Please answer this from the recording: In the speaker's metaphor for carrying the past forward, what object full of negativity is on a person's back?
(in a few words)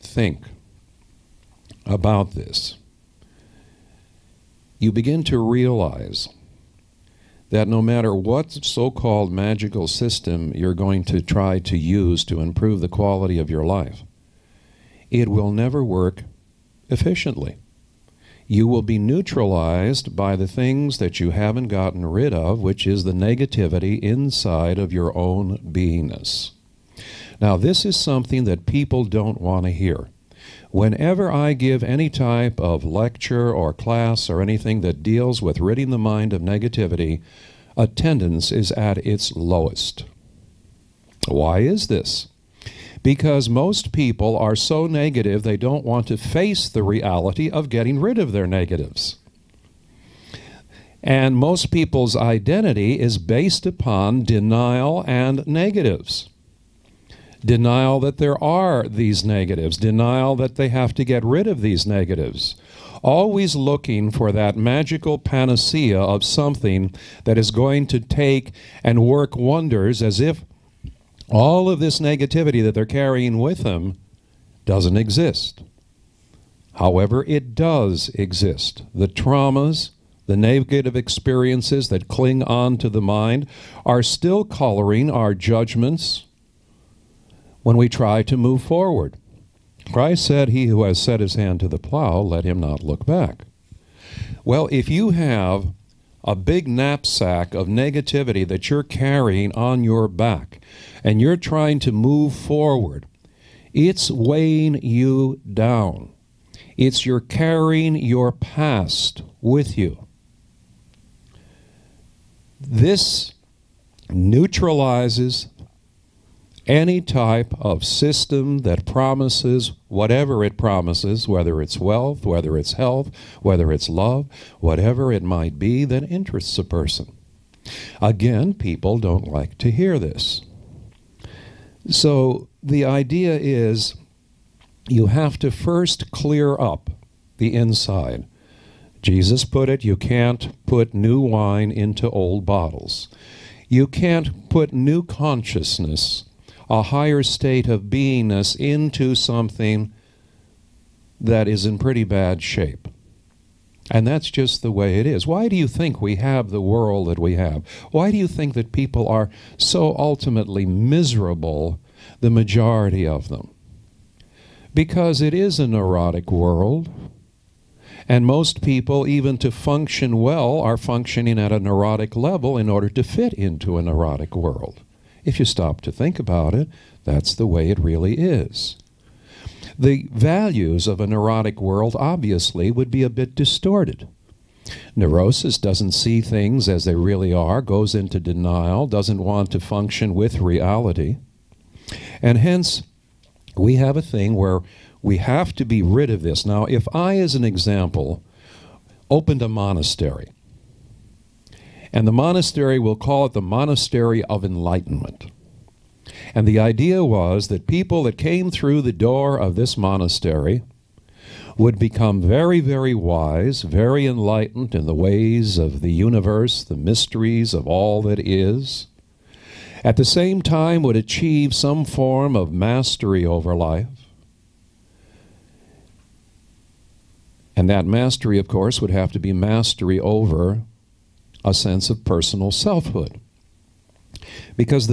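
knapsack.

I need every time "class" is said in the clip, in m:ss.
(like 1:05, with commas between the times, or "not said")
0:33.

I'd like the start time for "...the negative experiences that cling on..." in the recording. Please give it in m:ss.
1:20.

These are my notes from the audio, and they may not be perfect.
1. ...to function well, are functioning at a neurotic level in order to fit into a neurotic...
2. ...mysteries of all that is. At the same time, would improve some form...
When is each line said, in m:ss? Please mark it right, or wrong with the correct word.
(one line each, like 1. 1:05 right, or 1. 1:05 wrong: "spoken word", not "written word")
1. 2:49 right
2. 3:36 wrong: "achieve", not "improve".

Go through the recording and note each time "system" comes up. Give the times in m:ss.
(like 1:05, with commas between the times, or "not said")
0:09, 1:57.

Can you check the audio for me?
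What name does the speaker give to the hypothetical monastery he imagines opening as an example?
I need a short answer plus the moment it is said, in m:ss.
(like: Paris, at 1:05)
Monastery of Enlightenment, at 3:23.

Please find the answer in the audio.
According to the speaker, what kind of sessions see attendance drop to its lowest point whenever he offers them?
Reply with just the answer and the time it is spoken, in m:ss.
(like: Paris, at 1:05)
ridding the mind of negativity, at 0:35.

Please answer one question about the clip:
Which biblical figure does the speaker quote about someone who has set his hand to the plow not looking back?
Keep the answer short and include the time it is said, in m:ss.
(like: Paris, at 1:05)
Christ, at 1:29.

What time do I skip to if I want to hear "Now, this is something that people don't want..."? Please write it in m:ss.
0:27.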